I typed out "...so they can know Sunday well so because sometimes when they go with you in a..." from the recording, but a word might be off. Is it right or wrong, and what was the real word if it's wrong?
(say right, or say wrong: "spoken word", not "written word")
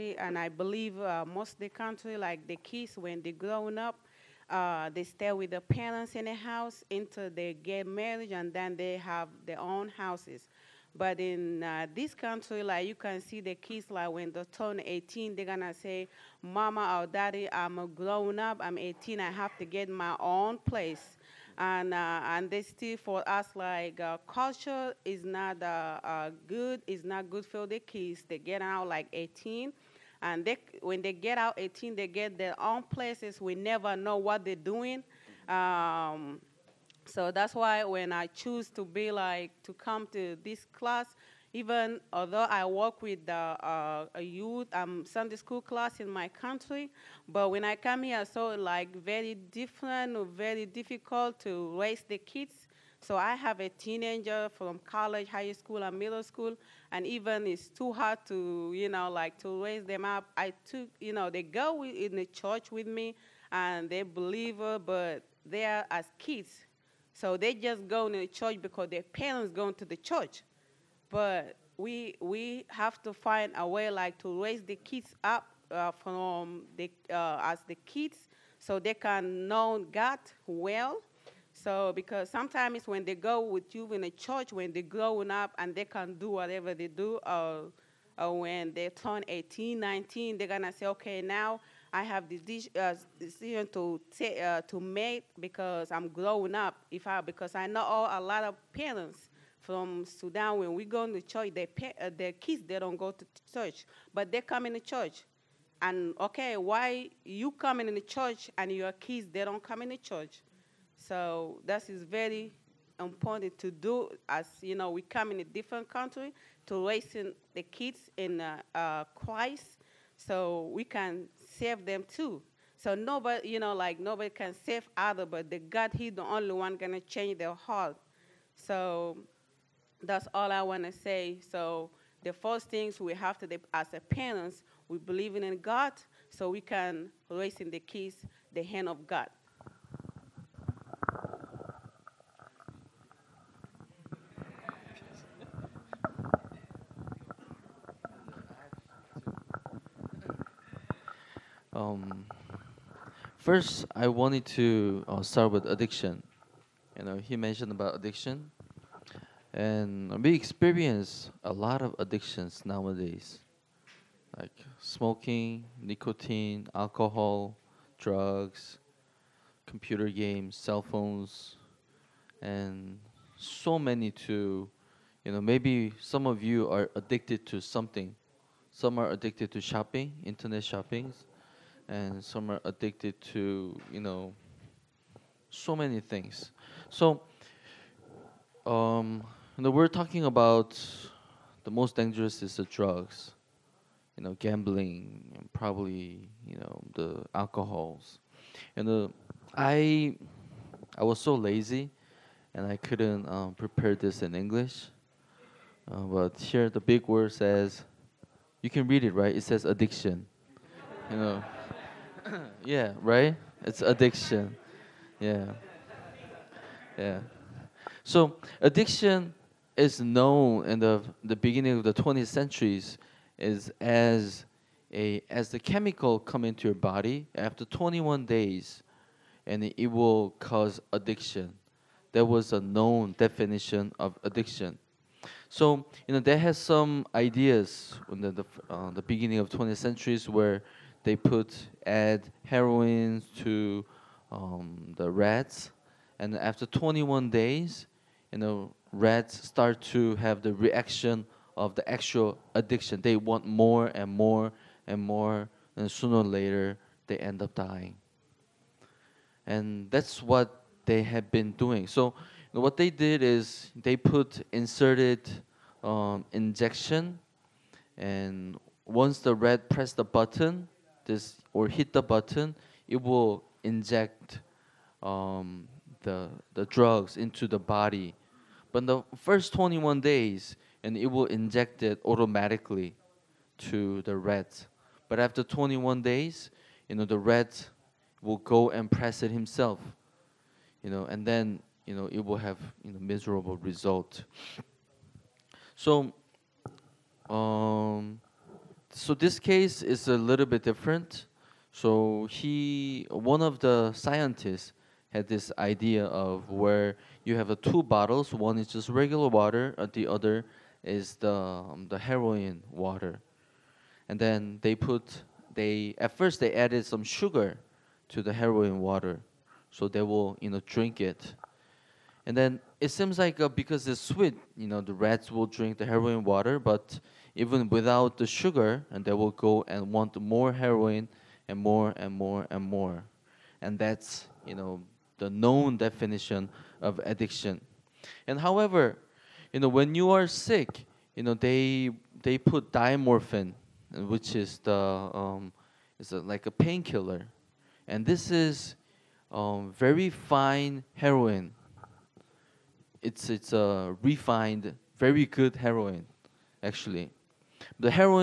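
wrong: "God", not "Sunday".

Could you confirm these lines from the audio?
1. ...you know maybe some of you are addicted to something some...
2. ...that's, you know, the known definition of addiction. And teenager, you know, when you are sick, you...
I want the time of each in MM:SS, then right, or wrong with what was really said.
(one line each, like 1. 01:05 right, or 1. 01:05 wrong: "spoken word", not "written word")
1. 02:55 right
2. 05:33 wrong: "however", not "teenager".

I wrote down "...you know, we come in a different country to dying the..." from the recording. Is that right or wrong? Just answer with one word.
wrong.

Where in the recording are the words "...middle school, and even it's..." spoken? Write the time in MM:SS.
00:55.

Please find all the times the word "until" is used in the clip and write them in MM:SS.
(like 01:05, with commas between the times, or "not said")
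00:06.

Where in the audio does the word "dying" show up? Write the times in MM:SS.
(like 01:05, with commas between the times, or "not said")
04:17.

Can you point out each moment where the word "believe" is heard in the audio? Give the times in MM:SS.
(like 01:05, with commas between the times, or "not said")
00:00, 01:04, 02:14.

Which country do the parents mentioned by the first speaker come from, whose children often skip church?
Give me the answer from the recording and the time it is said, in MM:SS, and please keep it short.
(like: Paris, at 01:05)
Sudan, at 01:40.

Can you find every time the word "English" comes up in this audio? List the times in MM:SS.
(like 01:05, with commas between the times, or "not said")
03:24.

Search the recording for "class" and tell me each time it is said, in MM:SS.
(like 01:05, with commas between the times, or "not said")
00:40, 00:45.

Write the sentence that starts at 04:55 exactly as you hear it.
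So, um, so this case is a little bit different.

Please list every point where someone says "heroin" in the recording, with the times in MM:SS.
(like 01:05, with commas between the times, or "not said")
04:02, 05:11, 05:18, 05:25, 05:30, 05:50, 05:55.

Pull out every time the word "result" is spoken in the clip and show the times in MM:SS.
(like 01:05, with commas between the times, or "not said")
04:53.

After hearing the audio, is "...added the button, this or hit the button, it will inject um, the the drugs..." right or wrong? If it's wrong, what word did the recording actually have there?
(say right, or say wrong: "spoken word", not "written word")
wrong: "pressed", not "added".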